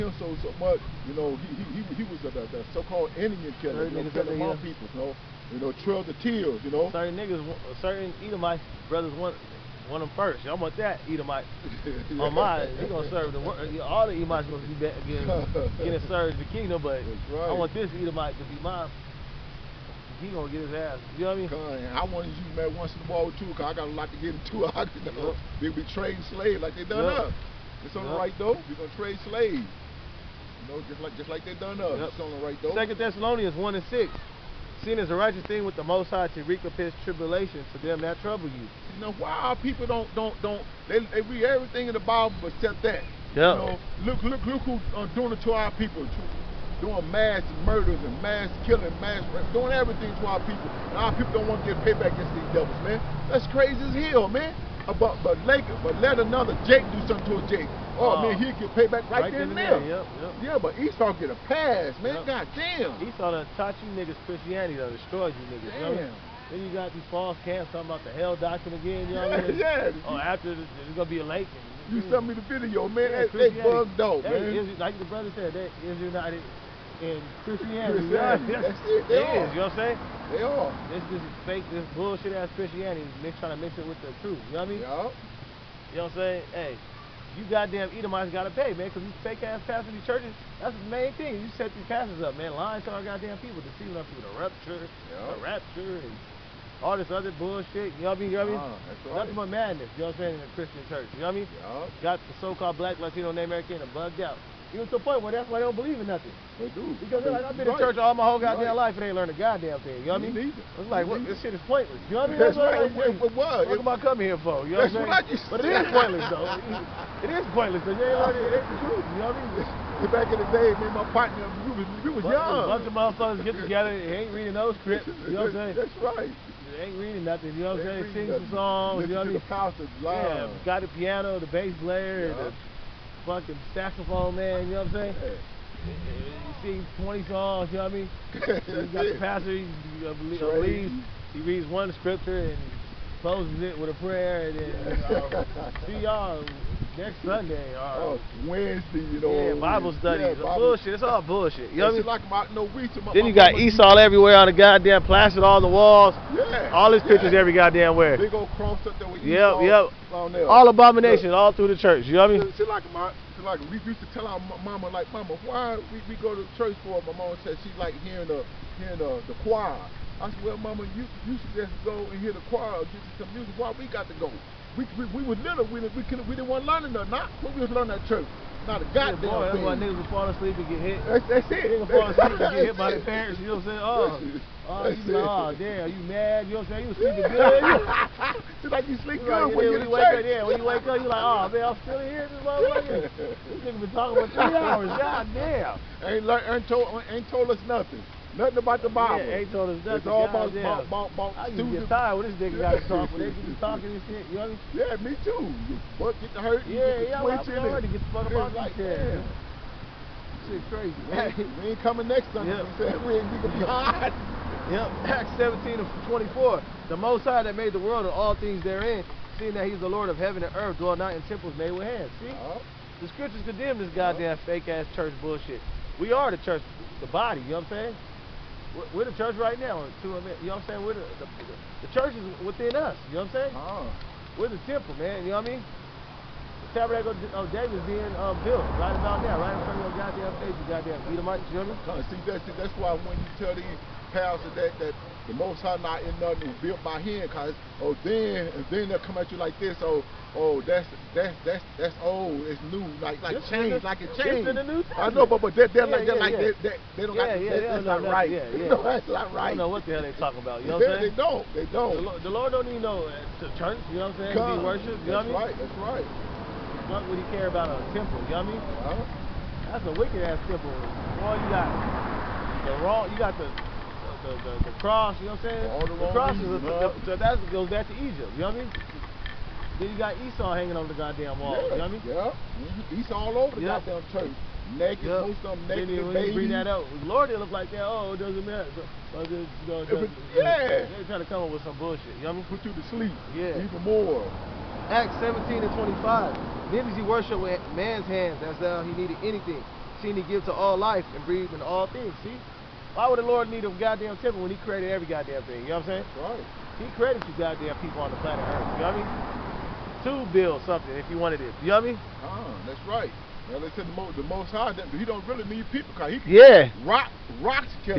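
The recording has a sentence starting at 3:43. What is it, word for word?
the Scriptures condemn this goddamn uh -huh.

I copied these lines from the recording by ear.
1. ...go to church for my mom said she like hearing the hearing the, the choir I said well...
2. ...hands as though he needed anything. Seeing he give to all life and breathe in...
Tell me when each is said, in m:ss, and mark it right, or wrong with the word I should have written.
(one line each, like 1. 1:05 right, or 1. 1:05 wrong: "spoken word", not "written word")
1. 2:46 right
2. 4:58 right.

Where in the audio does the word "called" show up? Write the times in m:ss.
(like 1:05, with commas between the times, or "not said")
0:02, 1:42.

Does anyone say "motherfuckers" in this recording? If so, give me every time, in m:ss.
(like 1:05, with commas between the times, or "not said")
2:02, 3:12.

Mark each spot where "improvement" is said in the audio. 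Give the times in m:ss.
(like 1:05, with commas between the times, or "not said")
not said.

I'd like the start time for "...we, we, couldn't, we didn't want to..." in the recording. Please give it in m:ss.
2:55.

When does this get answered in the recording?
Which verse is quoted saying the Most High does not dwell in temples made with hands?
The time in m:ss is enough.
3:35.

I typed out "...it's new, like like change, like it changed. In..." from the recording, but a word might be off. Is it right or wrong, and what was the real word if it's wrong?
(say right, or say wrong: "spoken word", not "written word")
right.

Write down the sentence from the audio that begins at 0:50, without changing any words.
And our people don't want to get payback against these devils, man.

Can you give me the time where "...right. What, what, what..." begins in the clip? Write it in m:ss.
1:52.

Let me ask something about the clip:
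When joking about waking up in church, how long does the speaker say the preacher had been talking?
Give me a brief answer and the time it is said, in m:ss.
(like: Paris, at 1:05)
3 hours, at 3:14.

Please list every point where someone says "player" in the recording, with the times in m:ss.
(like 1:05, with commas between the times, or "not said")
2:11.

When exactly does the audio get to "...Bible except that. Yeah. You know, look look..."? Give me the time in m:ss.
0:42.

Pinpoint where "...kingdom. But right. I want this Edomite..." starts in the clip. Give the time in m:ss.
0:16.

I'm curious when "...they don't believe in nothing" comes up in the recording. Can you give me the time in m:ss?
1:45.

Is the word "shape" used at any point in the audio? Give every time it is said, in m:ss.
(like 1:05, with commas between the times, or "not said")
not said.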